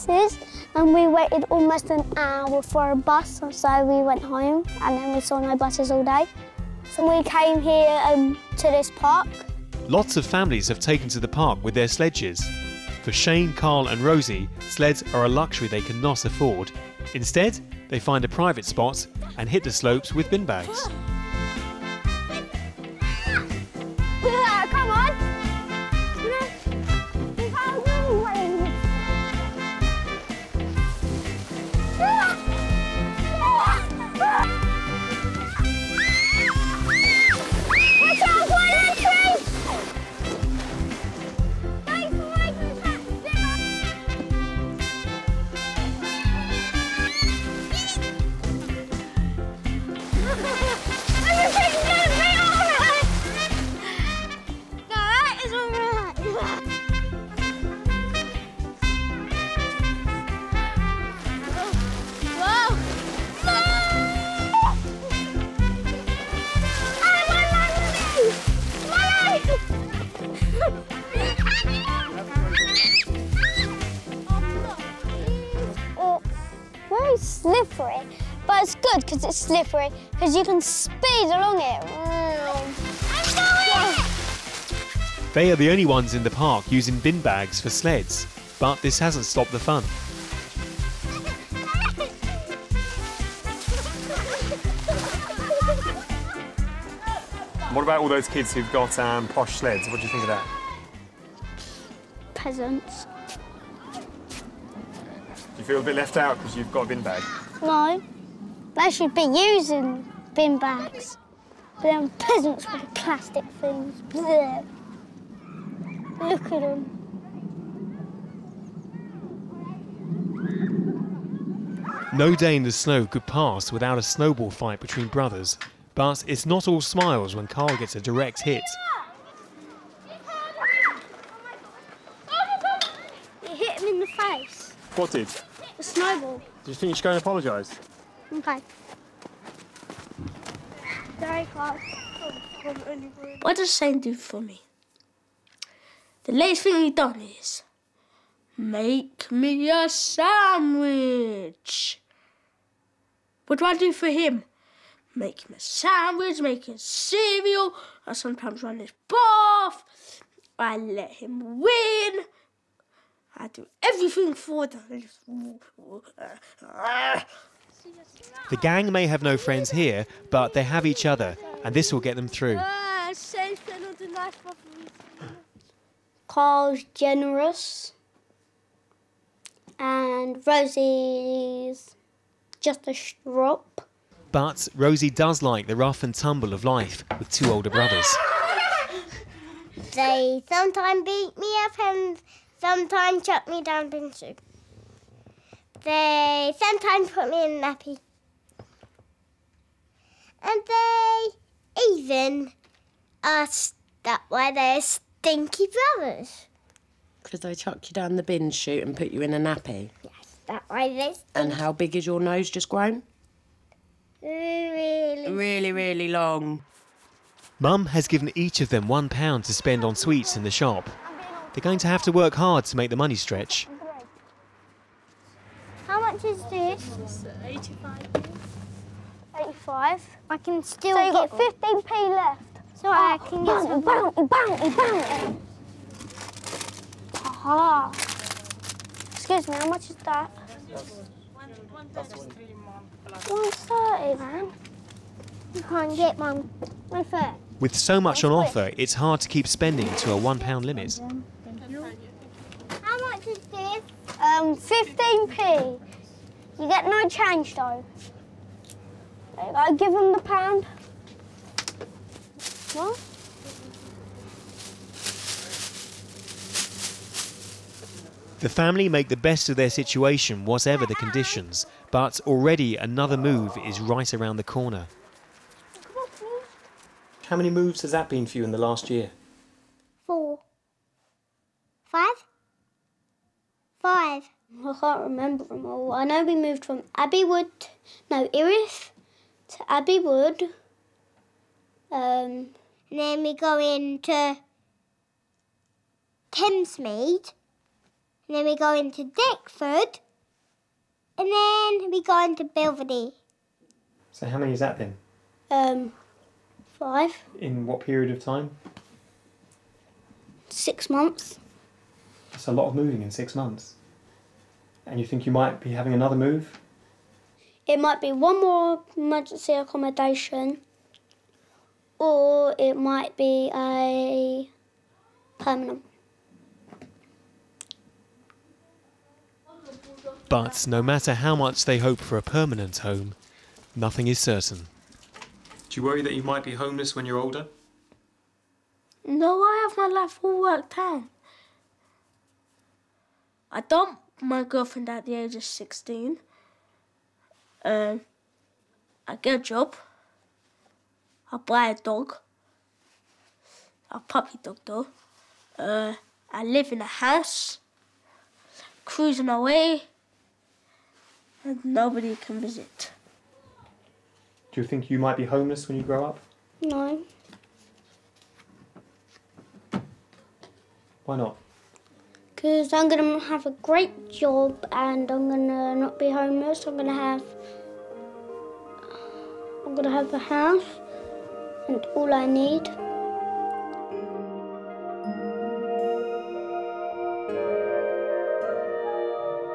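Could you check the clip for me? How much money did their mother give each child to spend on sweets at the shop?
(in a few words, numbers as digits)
£1.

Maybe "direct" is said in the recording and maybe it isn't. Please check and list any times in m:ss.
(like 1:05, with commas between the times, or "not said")
2:08.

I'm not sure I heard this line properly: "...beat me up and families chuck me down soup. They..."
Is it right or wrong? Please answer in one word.
wrong.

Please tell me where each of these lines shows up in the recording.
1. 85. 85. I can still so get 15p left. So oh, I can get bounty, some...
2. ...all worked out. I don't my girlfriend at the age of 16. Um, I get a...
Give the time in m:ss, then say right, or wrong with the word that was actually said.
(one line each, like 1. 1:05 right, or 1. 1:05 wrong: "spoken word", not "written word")
1. 3:47 right
2. 5:40 right.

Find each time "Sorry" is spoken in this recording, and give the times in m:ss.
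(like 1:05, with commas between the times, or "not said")
2:21.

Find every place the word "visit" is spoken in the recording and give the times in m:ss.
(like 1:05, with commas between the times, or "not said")
6:02.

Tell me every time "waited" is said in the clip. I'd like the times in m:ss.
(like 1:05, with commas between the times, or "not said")
0:01.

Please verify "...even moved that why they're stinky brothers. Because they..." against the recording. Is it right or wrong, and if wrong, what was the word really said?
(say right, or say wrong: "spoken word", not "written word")
wrong: "asked", not "moved".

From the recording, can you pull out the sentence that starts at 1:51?
But are peasants with plastic things.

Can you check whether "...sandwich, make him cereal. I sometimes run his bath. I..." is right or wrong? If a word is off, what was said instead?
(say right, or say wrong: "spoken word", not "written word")
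right.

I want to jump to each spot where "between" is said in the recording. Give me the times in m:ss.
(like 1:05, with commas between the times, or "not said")
2:04.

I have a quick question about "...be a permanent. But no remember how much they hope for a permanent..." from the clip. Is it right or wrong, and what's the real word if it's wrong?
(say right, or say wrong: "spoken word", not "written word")
wrong: "matter", not "remember".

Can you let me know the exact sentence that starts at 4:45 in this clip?
I know we moved from Abbey Wood, no, Erith to Abbey Wood.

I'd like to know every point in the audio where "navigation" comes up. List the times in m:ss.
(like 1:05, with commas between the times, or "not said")
not said.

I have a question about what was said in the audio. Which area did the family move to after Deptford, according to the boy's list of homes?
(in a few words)
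Belvedere.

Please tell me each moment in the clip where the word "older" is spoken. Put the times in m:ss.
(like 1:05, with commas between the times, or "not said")
3:07, 5:37.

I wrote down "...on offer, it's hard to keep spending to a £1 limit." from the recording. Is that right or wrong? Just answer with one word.
right.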